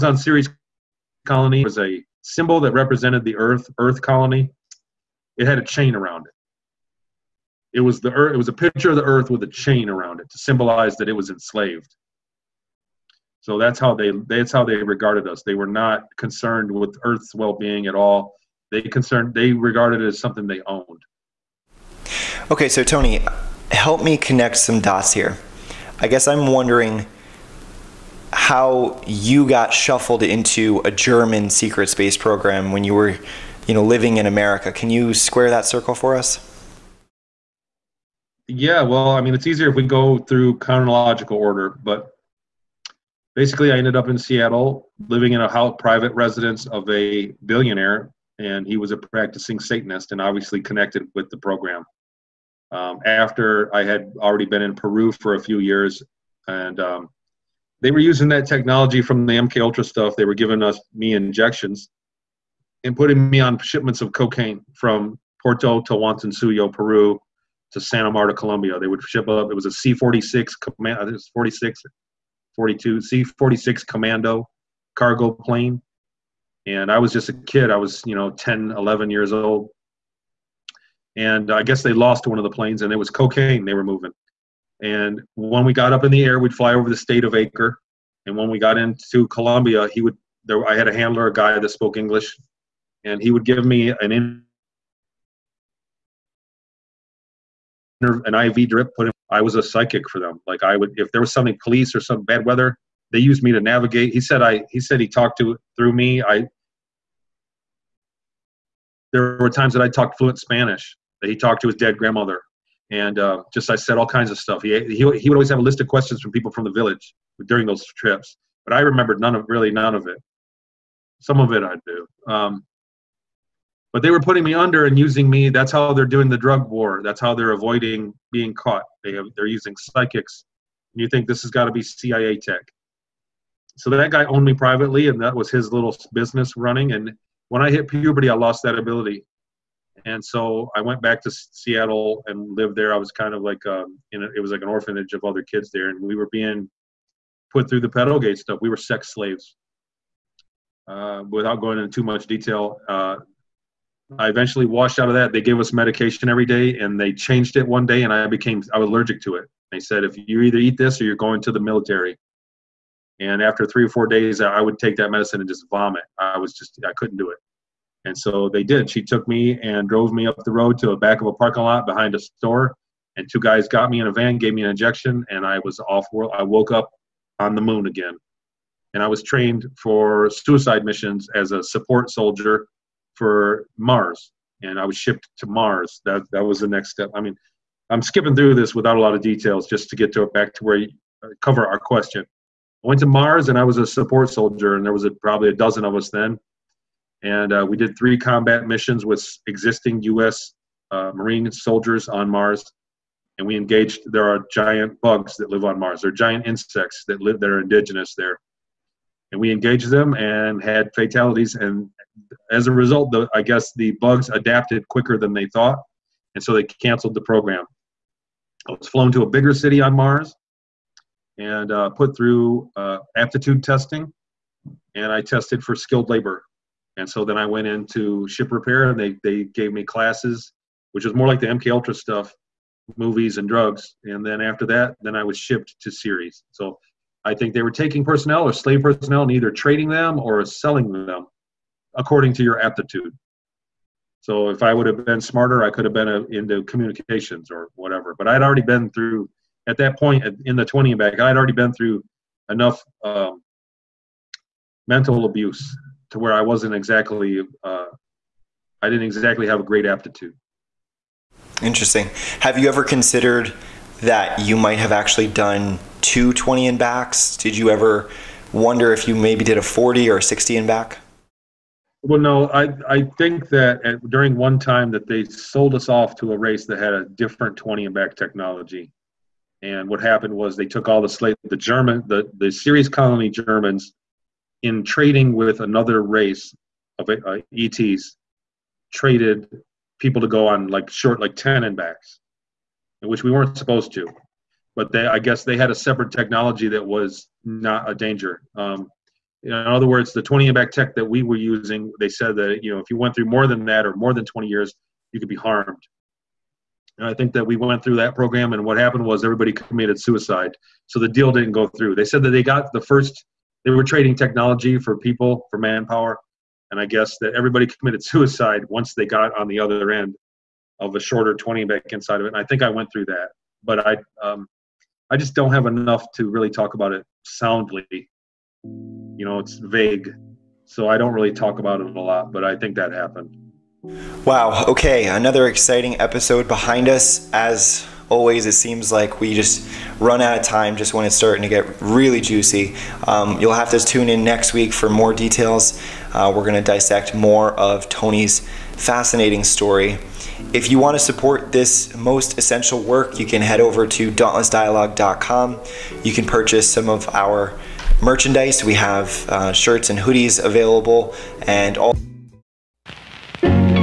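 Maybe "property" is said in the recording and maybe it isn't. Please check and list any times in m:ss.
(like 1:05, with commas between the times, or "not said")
not said.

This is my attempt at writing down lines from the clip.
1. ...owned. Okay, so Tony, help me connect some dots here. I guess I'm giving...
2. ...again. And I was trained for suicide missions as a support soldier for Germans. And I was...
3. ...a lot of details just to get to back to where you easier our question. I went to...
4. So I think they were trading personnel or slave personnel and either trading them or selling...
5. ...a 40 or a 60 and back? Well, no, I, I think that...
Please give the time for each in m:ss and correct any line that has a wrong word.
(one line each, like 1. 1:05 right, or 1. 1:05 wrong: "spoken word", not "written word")
1. 0:20 wrong: "wondering", not "giving"
2. 2:57 wrong: "Mars", not "Germans"
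3. 3:08 wrong: "cover", not "easier"
4. 3:56 wrong: "taking", not "trading"
5. 4:29 right.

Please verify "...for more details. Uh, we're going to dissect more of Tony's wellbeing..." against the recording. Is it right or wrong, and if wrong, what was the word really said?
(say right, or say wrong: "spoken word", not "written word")
wrong: "fascinating", not "wellbeing".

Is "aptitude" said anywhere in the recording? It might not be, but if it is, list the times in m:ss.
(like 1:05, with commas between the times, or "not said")
3:43, 4:02, 4:19.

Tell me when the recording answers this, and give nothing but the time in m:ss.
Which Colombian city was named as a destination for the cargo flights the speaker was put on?
1:07.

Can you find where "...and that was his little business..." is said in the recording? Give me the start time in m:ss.
2:15.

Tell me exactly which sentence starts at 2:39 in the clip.
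They said, if you either eat this or you're going to the military.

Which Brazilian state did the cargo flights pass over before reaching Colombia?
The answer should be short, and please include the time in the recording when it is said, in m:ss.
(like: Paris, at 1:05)
Acre, at 1:27.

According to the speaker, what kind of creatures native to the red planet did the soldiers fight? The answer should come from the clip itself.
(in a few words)
Giant insects.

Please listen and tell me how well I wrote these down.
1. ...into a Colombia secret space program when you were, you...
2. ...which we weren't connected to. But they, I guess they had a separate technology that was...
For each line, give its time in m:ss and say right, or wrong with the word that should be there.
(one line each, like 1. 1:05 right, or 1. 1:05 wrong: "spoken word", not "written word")
1. 0:30 wrong: "German", not "Colombia"
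2. 4:53 wrong: "supposed", not "connected".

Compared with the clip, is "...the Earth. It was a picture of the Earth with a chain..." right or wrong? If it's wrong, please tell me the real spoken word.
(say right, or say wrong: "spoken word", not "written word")
right.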